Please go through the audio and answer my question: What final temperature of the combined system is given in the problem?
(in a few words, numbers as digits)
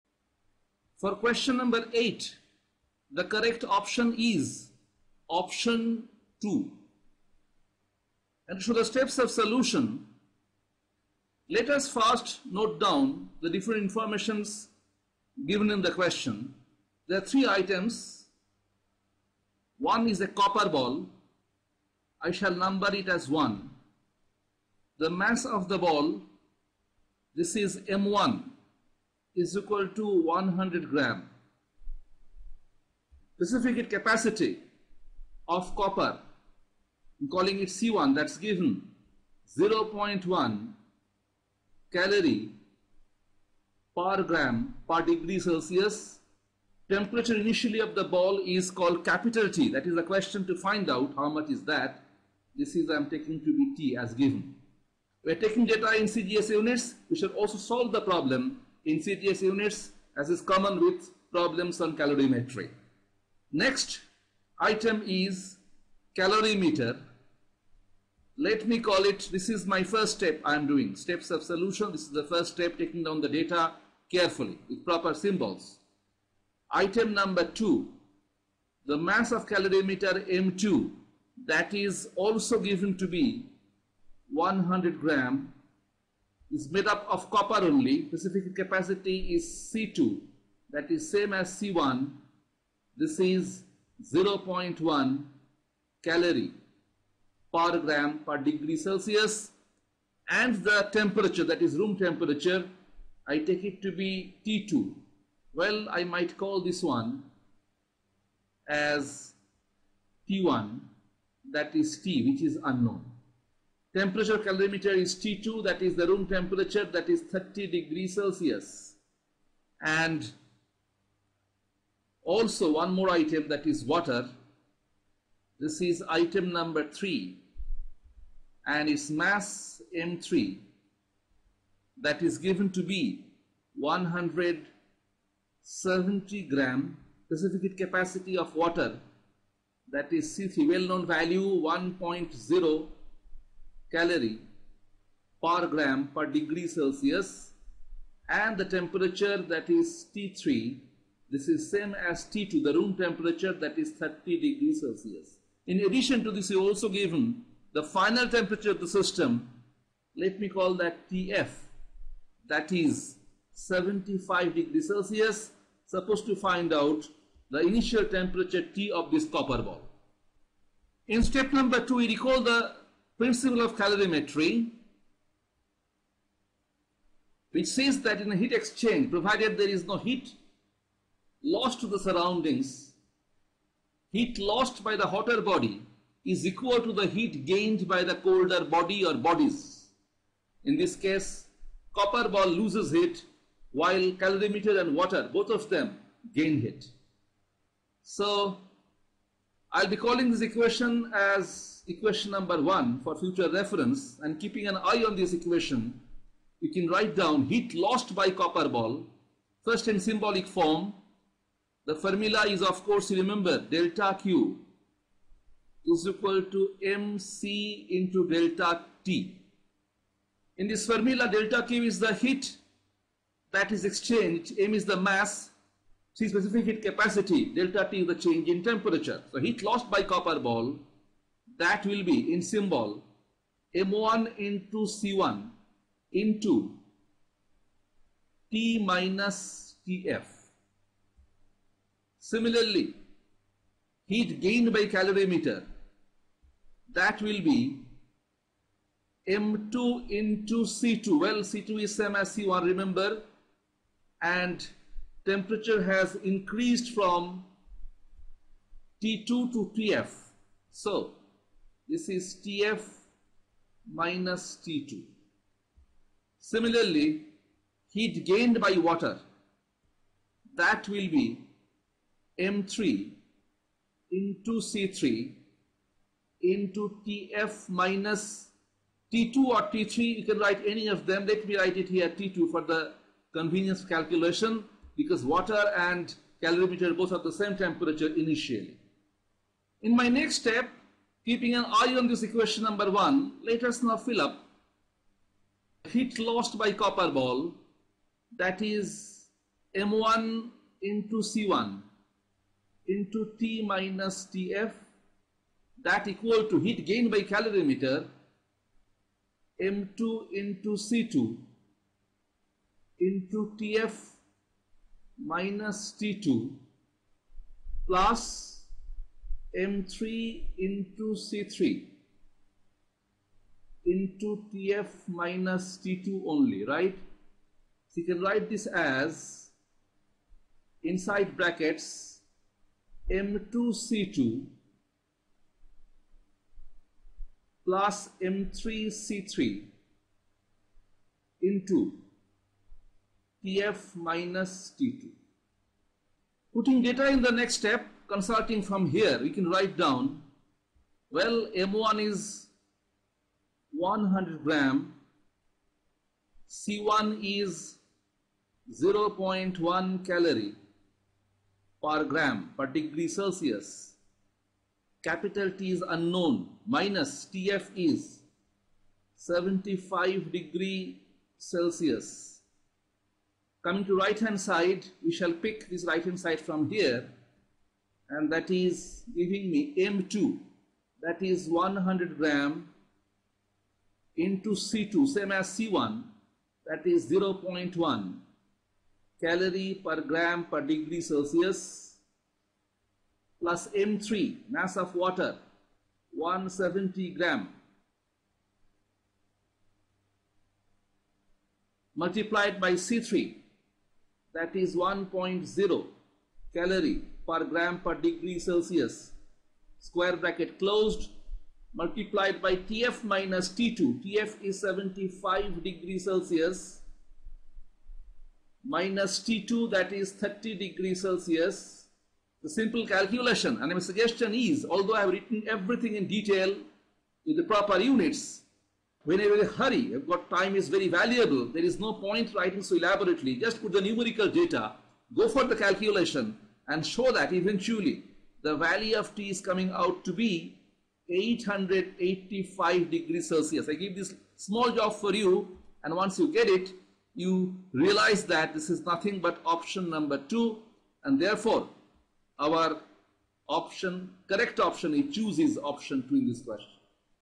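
75 degrees Celsius.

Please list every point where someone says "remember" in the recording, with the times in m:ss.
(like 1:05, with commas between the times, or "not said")
3:33, 4:12.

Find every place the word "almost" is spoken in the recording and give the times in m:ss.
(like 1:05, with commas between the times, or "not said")
not said.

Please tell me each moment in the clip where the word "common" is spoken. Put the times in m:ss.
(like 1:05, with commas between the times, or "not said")
1:00.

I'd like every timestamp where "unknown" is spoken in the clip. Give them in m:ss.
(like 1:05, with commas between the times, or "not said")
1:52, 6:05.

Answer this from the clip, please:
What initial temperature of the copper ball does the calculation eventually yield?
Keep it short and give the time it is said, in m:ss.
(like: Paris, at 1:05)
885 degrees Celsius, at 7:21.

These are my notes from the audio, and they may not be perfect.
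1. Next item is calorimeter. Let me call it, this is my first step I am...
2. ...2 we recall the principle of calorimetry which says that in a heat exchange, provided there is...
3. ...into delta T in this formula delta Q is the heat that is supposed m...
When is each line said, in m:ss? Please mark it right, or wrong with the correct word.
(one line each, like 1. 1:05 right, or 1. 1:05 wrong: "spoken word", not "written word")
1. 1:03 right
2. 2:51 right
3. 3:37 wrong: "exchanged", not "supposed".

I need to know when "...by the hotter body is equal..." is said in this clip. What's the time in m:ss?
3:04.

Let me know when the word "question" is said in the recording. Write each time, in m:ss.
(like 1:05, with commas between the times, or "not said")
0:01, 0:15, 0:50, 7:36.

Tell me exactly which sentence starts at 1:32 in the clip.
This is 0.1 calorie per gram per degree Celsius and the temperature that is room temperature I take it to be T2.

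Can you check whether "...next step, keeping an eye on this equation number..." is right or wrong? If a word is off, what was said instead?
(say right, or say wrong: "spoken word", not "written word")
right.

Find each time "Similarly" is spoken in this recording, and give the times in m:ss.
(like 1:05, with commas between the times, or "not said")
4:02, 4:26.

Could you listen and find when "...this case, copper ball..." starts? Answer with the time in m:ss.
3:10.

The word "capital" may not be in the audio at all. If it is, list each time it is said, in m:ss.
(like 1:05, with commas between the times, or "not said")
0:49, 6:05.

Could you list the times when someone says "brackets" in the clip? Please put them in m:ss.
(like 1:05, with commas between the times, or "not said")
5:31, 6:50.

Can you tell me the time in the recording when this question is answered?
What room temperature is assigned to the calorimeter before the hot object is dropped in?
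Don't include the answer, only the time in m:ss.
1:56.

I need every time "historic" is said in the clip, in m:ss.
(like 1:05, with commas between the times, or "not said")
not said.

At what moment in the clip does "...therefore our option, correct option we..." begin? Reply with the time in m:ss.
7:31.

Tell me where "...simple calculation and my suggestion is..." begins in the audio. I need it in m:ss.
7:02.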